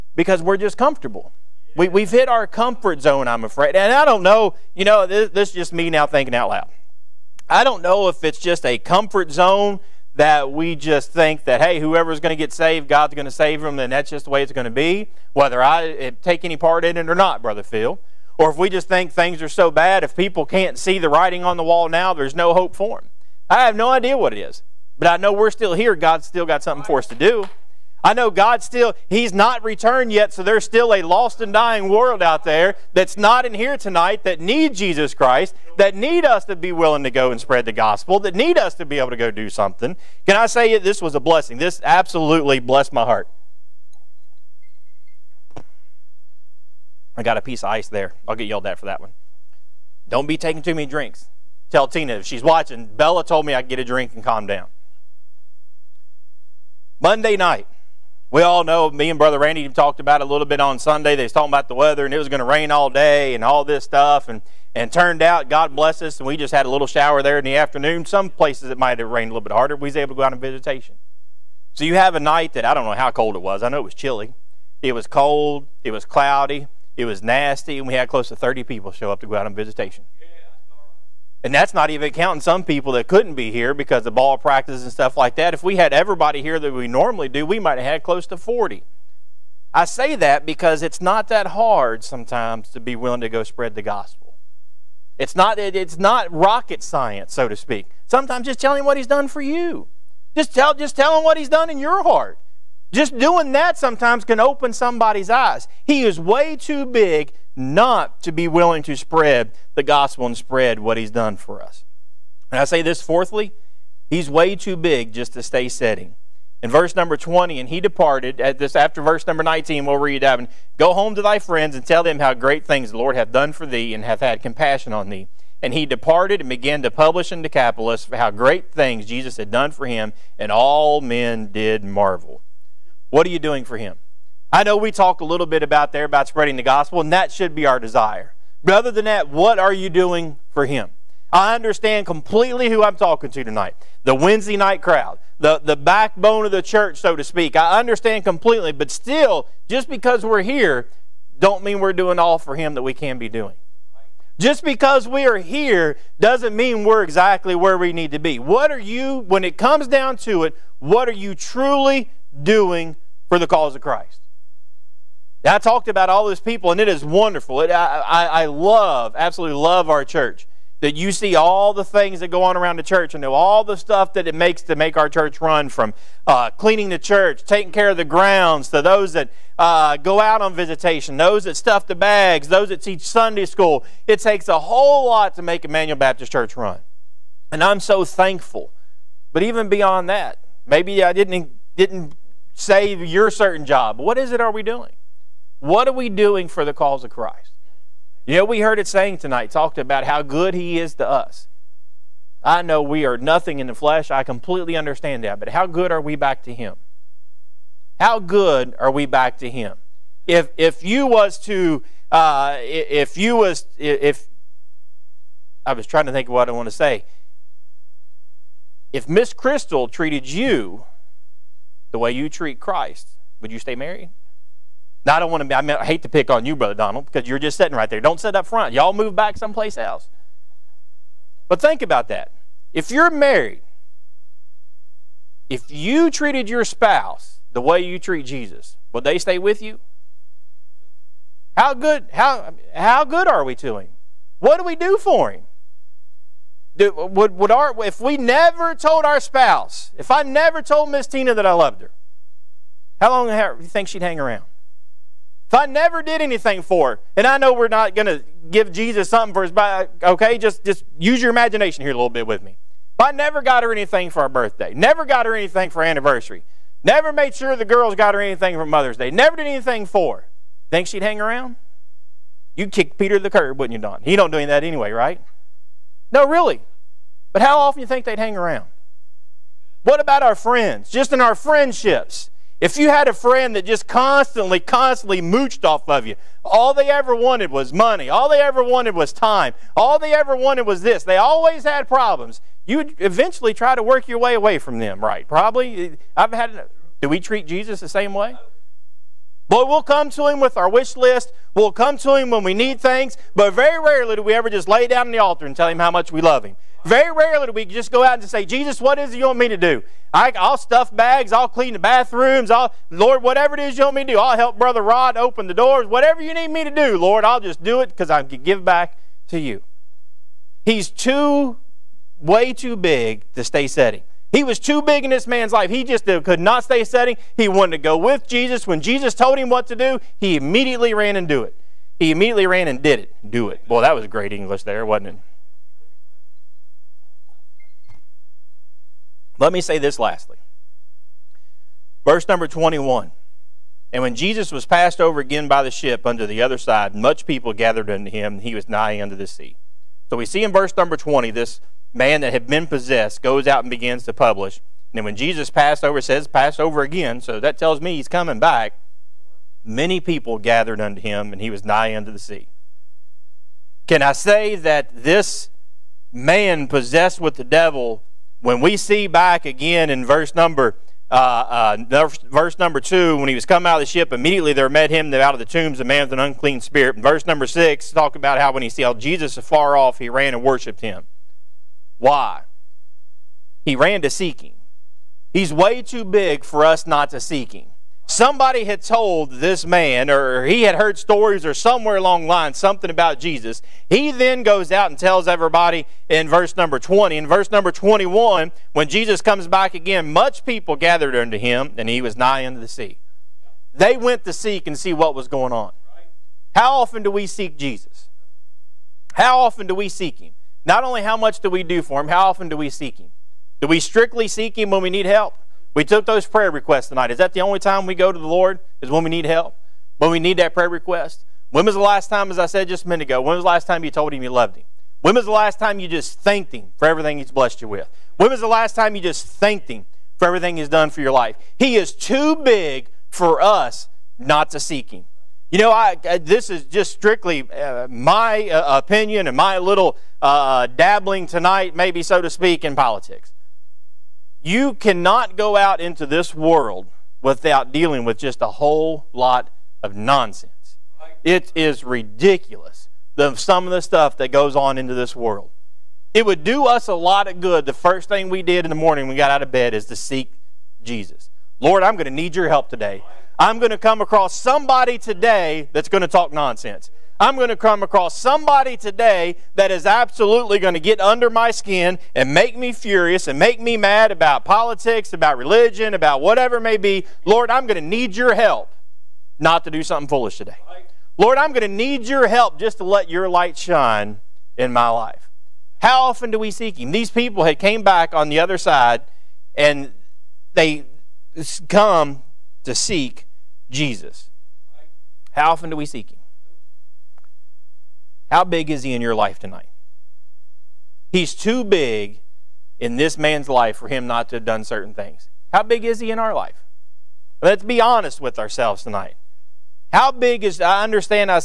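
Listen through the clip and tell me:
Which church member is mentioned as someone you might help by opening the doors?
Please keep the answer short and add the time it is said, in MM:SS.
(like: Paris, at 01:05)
Brother Rod, at 05:14.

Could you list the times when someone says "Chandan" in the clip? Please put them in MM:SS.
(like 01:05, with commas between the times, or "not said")
not said.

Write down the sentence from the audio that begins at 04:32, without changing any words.
You'd kick Peter to the curb, wouldn't you, Don?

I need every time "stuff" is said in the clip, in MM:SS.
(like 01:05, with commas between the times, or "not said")
01:03, 01:24, 02:53, 03:01, 05:10, 07:33.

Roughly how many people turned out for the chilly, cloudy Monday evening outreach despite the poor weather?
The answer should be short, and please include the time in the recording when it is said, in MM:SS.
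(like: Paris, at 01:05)
30, at 01:18.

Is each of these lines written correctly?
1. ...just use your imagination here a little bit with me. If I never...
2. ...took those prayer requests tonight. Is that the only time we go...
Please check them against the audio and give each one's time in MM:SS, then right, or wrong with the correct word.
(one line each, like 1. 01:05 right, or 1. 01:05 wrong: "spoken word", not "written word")
1. 04:20 right
2. 06:55 right.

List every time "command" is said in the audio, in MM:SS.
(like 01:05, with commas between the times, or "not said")
not said.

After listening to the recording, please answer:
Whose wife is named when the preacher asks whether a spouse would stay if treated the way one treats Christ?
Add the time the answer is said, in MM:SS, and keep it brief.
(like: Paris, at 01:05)
Brother Donald, at 03:46.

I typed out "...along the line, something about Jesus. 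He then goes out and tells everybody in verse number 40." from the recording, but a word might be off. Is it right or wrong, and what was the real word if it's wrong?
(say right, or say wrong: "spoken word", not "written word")
wrong: "20", not "40".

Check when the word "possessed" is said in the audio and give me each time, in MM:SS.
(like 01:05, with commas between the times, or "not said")
05:52, 06:06.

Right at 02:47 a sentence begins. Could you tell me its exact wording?
It, I, I, love, absolutely love our church.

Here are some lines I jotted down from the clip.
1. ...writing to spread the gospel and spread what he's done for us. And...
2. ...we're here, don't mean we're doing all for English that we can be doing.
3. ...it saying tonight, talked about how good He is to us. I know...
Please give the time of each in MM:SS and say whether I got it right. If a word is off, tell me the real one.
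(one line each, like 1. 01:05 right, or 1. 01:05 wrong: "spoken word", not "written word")
1. 01:48 wrong: "willing", not "writing"
2. 02:30 wrong: "Him", not "English"
3. 03:18 right.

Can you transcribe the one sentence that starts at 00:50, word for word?
Don't be taking too many drinks.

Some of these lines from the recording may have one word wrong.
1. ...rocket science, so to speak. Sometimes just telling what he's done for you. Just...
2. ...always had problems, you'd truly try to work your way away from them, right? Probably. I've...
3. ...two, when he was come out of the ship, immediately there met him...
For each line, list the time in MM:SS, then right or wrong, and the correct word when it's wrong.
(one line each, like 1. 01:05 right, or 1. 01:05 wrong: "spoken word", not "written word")
1. 01:36 right
2. 04:51 wrong: "eventually", not "truly"
3. 06:12 right.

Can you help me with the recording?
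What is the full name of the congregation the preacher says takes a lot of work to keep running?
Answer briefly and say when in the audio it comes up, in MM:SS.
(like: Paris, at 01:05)
Immanuel Baptist Church, at 03:05.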